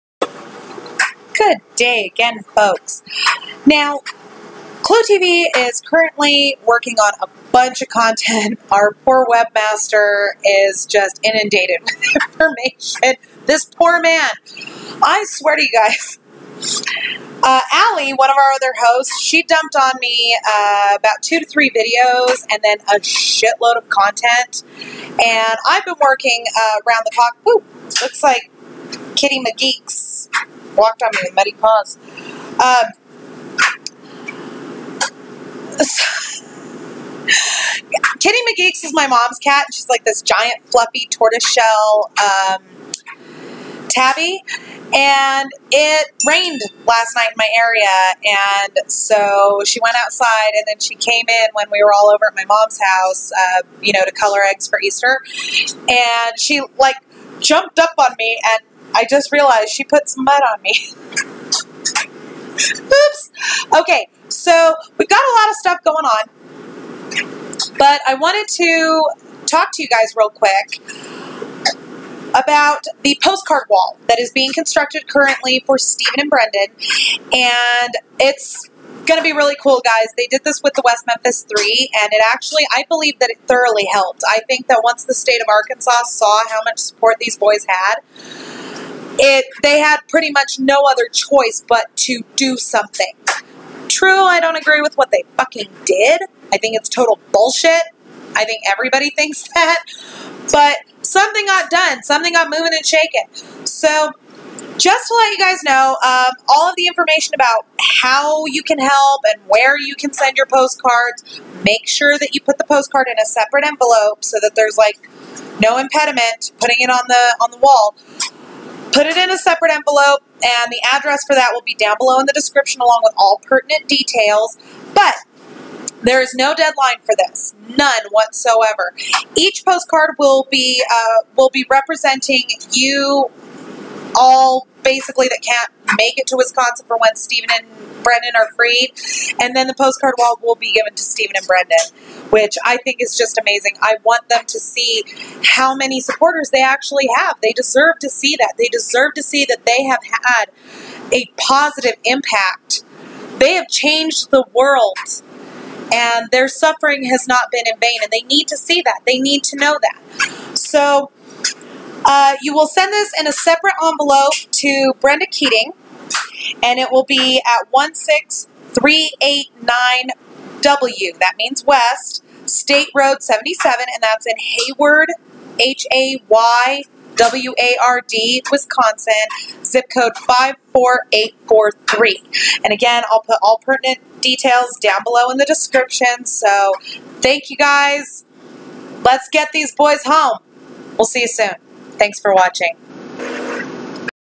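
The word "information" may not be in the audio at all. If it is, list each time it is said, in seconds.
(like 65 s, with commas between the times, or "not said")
12 s, 106 s.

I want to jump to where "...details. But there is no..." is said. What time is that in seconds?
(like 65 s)
123 s.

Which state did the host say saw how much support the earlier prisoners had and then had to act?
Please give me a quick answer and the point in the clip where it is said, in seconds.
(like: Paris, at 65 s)
Arkansas, at 85 s.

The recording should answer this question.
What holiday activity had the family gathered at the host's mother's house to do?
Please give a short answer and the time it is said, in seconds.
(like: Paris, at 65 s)
color eggs for Easter, at 54 s.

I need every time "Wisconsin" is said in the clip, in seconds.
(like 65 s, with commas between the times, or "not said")
136 s, 178 s.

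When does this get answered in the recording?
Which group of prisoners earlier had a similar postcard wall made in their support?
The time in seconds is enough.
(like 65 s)
80 s.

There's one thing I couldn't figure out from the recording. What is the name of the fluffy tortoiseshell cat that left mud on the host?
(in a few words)
Kitty McGee.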